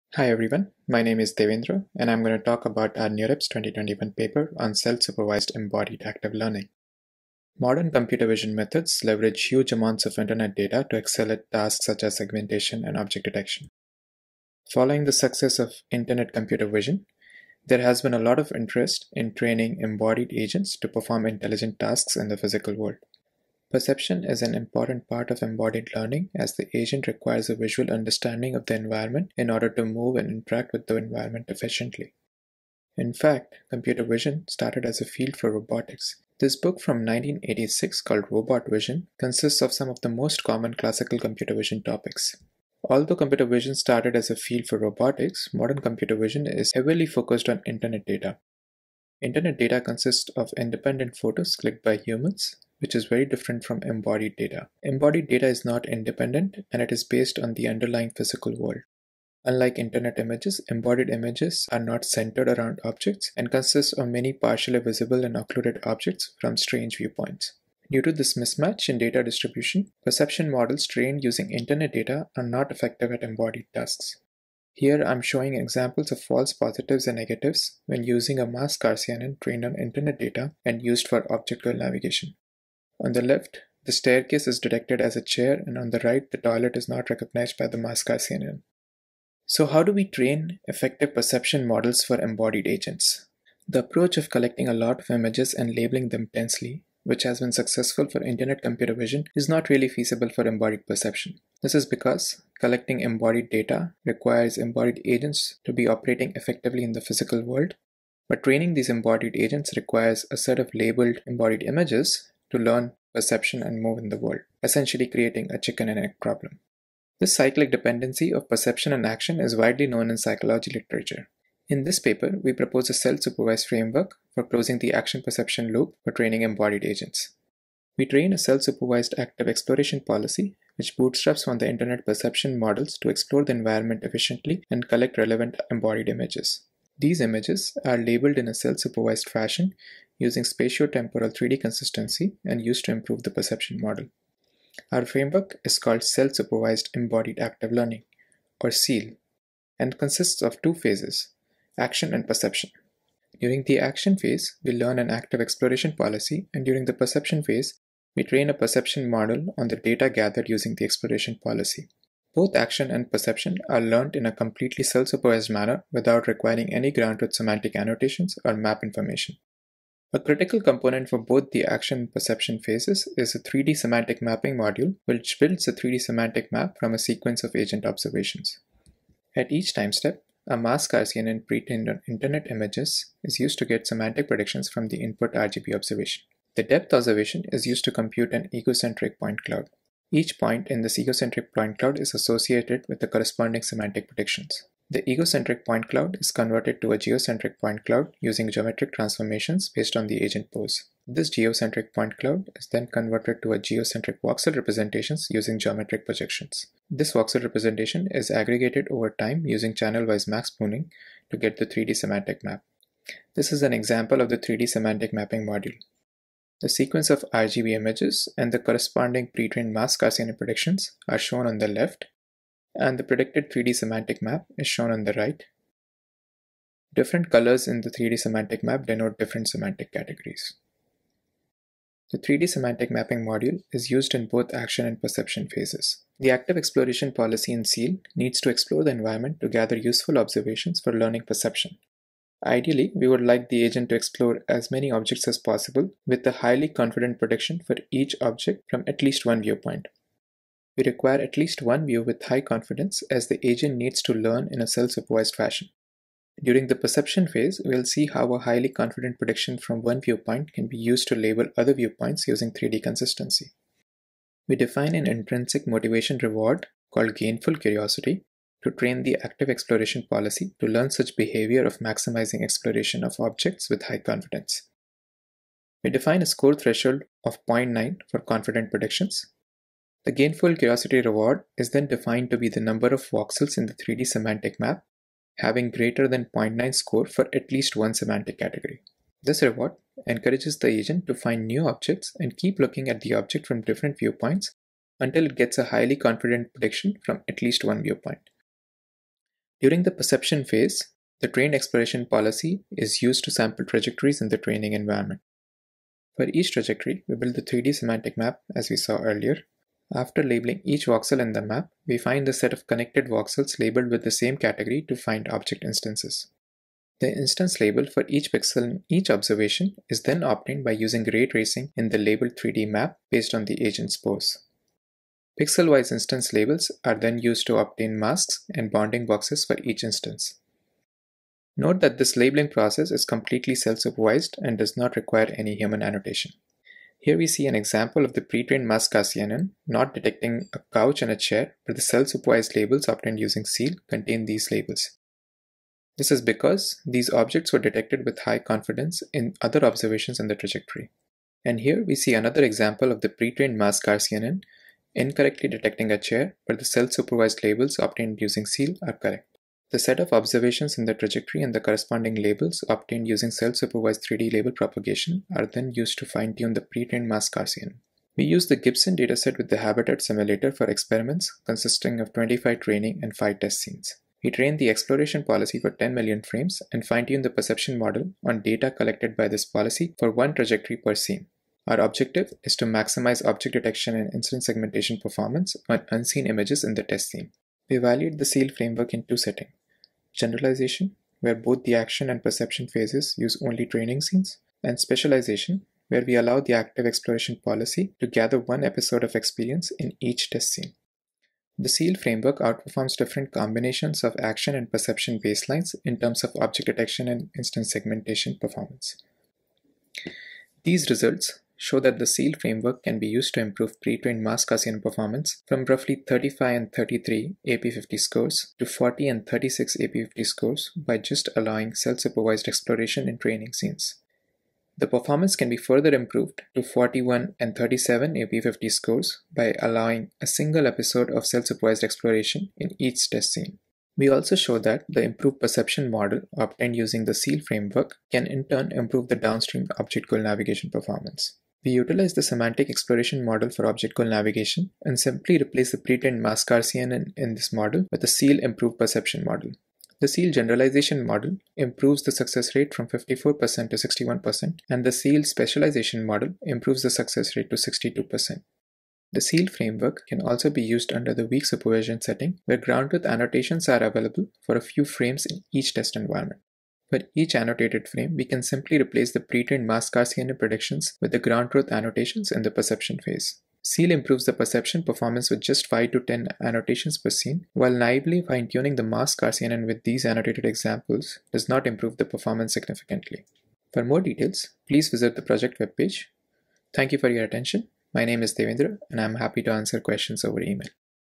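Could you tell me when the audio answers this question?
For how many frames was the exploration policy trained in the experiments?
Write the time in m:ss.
6:15.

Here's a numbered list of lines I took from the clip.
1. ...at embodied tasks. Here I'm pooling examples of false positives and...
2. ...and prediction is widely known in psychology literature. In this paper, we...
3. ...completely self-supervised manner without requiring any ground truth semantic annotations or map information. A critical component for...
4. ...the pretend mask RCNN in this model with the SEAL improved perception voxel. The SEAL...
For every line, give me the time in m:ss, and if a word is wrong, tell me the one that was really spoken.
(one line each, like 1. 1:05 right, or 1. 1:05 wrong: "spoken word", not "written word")
1. 1:13 wrong: "showing", not "pooling"
2. 1:58 wrong: "action", not "prediction"
3. 2:44 right
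4. 7:25 wrong: "model", not "voxel".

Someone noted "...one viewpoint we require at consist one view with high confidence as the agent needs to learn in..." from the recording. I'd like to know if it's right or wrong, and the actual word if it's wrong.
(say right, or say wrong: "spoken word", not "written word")
wrong: "least", not "consist".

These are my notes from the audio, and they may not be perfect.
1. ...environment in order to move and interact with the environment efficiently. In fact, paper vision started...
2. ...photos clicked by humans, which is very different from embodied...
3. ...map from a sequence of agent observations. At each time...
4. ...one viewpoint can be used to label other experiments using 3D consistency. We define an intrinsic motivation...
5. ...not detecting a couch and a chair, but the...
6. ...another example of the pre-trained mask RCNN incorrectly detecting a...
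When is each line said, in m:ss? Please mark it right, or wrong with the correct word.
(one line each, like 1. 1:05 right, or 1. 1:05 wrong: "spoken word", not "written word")
1. 0:28 wrong: "computer", not "paper"
2. 0:51 right
3. 2:56 right
4. 4:19 wrong: "viewpoints", not "experiments"
5. 5:39 right
6. 5:52 right.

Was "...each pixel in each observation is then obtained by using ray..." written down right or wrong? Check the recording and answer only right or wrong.
right.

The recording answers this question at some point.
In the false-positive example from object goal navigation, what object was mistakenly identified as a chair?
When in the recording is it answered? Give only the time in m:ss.
1:23.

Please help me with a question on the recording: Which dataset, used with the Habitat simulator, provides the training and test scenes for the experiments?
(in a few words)
Gibson.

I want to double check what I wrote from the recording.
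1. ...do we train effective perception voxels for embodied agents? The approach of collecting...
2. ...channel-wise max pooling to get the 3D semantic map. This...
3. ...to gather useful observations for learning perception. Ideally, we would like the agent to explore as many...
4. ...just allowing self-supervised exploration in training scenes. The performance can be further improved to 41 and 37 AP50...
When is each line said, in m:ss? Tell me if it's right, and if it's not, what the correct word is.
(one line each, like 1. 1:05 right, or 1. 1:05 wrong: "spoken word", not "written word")
1. 1:29 wrong: "models", not "voxels"
2. 3:29 right
3. 3:59 right
4. 7:00 right.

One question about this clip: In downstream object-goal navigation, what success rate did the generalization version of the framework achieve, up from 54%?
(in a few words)
61%.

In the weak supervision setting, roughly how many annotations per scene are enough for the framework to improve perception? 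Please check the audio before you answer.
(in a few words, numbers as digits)
5 to 10.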